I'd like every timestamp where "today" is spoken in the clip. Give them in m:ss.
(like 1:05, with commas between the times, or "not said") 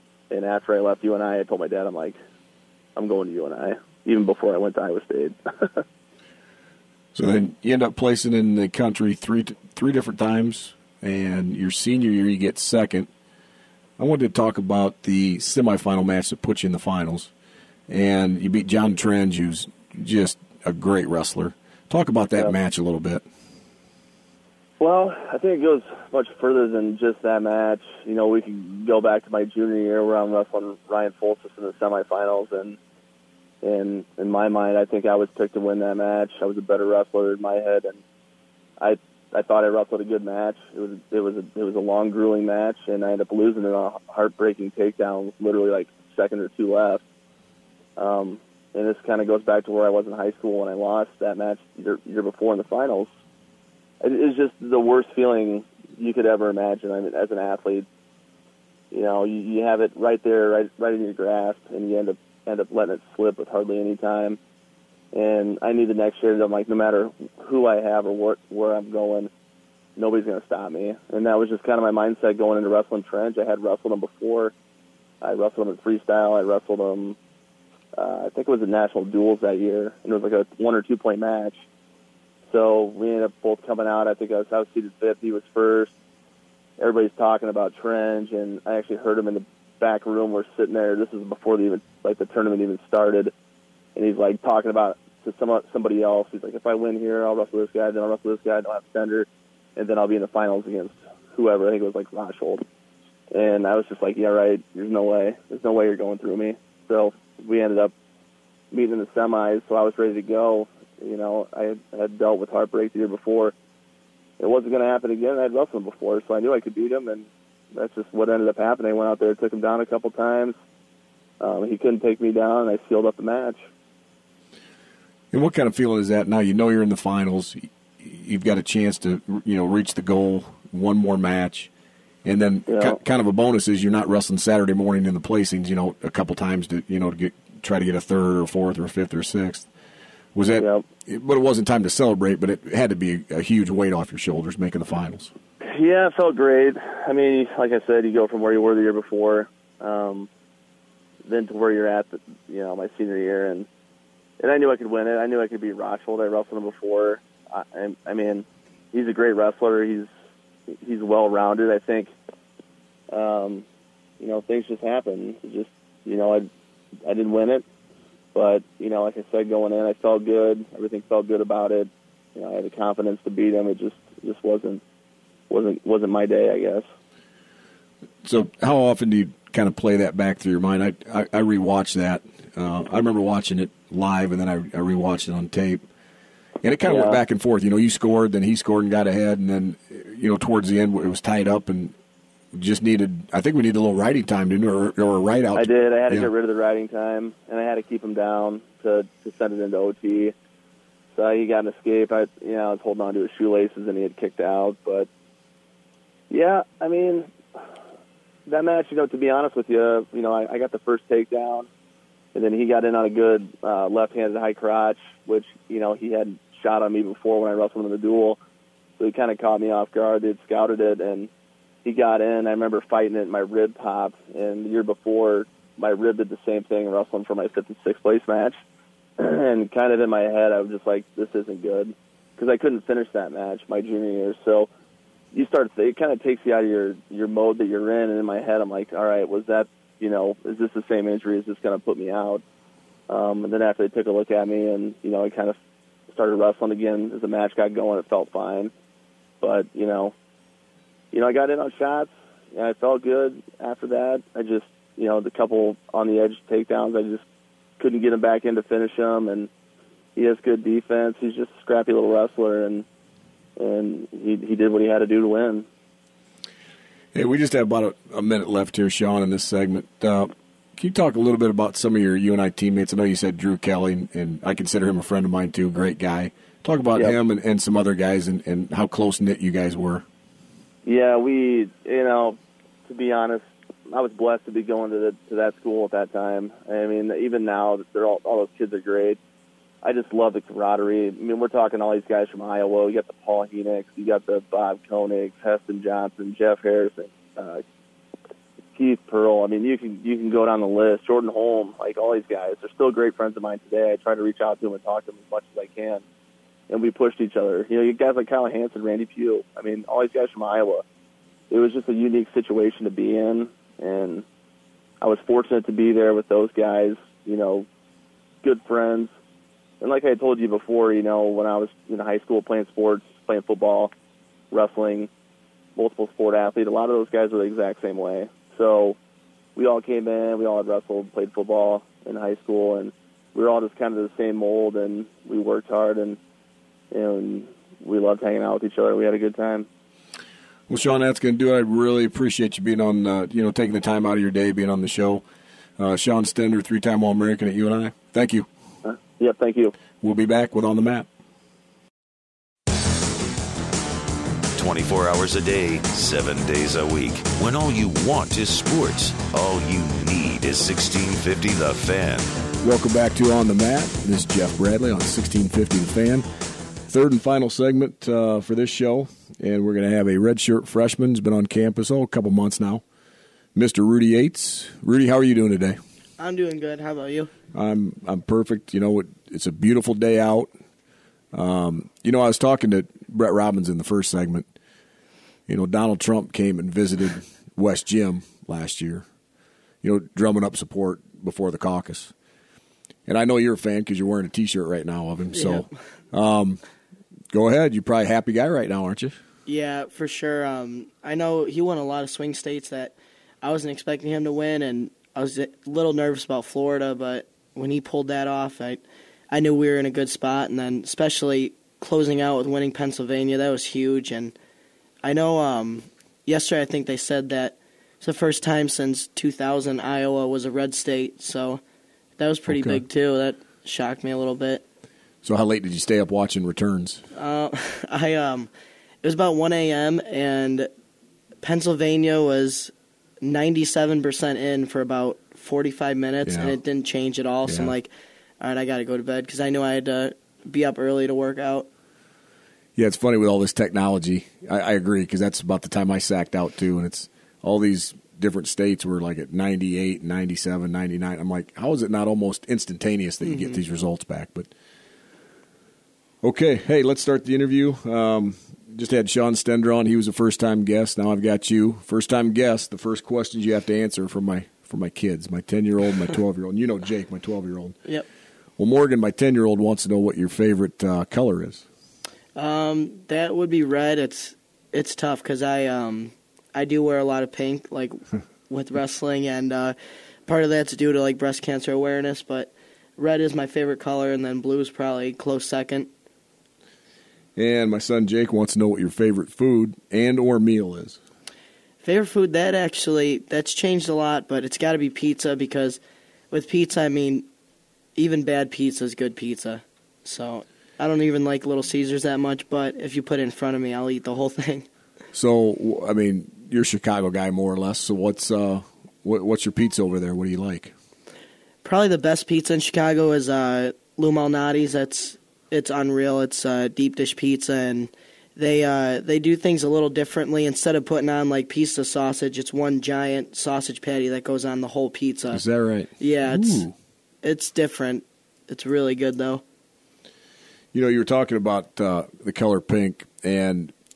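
5:03, 6:15.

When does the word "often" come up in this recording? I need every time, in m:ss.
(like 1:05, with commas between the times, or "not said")
2:58.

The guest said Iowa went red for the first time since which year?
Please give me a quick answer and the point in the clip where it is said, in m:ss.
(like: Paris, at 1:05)
2000, at 6:59.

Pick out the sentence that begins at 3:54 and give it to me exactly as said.
So you start, it kind of takes you out of your, your mode that you're in.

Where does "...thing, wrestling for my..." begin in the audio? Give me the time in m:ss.
3:46.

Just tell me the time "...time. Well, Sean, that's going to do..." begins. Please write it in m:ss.
5:39.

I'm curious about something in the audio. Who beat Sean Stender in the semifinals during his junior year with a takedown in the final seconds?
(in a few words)
Ryan Foltis.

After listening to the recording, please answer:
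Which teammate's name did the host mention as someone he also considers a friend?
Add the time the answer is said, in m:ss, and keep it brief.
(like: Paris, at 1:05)
Drew Kelly, at 4:33.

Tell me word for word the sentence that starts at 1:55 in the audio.
I would wrestled him before, so I knew I could beat him, and that's just what ended up happening.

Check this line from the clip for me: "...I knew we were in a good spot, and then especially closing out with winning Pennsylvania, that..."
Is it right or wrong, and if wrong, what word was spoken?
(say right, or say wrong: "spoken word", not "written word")
right.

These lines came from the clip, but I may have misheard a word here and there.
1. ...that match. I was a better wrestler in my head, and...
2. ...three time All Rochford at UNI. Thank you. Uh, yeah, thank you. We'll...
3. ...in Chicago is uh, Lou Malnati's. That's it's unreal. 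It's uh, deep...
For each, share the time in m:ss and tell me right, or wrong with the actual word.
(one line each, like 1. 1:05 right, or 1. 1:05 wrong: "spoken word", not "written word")
1. 0:35 right
2. 5:46 wrong: "American", not "Rochford"
3. 8:32 right.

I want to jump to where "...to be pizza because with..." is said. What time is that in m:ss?
8:14.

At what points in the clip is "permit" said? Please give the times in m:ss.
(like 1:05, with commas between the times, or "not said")
not said.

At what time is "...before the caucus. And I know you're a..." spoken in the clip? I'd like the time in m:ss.
6:31.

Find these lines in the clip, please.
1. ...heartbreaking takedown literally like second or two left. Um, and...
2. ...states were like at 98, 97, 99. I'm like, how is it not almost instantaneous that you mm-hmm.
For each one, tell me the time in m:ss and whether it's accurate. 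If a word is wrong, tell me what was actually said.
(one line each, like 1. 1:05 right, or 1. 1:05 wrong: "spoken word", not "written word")
1. 0:44 right
2. 7:28 right.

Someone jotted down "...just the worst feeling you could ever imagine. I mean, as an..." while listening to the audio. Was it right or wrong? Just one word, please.
right.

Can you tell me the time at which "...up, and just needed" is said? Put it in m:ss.
3:11.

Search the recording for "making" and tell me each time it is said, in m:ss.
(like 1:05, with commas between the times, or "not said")
2:24.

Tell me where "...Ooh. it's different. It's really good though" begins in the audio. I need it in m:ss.
8:46.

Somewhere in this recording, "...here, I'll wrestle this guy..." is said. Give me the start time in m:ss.
1:37.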